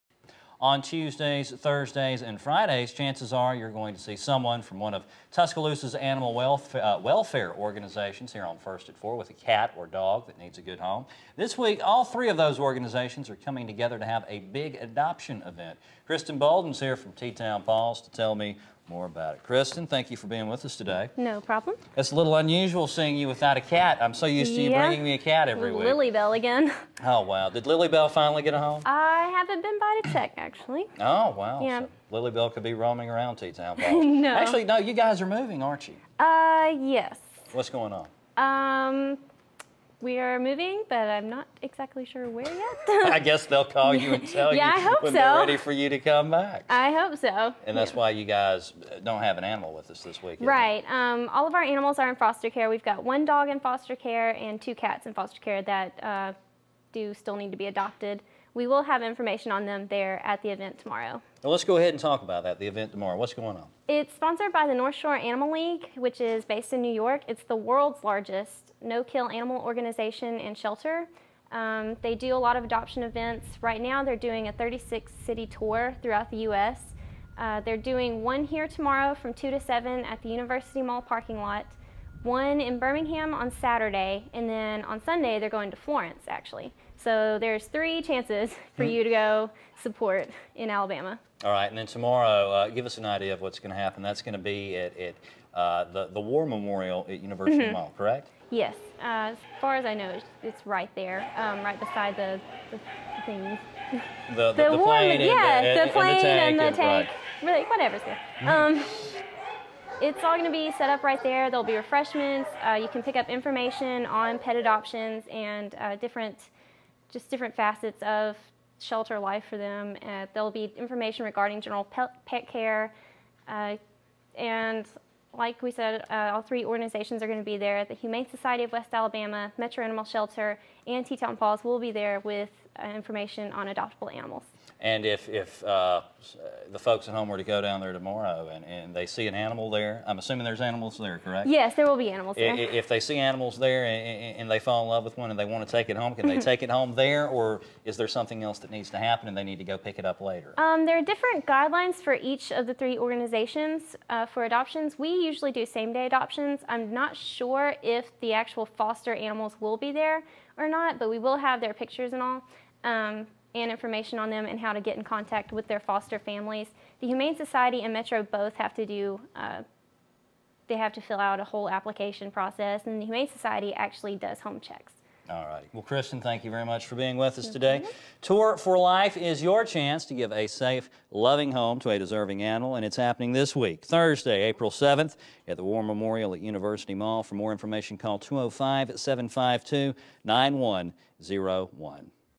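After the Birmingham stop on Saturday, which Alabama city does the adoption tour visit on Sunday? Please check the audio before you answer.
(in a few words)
Florence.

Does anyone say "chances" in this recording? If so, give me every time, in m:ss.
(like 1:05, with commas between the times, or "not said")
0:02, 1:28, 2:59.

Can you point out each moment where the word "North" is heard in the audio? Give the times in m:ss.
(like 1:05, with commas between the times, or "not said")
1:04.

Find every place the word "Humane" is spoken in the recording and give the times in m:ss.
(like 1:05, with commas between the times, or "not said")
2:07, 2:47, 2:53.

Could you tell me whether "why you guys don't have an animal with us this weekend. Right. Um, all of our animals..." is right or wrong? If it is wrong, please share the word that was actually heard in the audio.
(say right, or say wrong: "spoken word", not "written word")
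right.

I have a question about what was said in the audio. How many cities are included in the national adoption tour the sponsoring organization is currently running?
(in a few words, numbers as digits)
36.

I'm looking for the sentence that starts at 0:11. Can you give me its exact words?
This week, all three of those organizations are coming together to have a big adoption event.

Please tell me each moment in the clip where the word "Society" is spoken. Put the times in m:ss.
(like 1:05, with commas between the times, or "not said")
2:08, 2:47, 2:53.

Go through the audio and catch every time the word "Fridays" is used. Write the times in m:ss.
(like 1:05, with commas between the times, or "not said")
0:02.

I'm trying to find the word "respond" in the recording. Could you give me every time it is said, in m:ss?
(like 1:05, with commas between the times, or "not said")
not said.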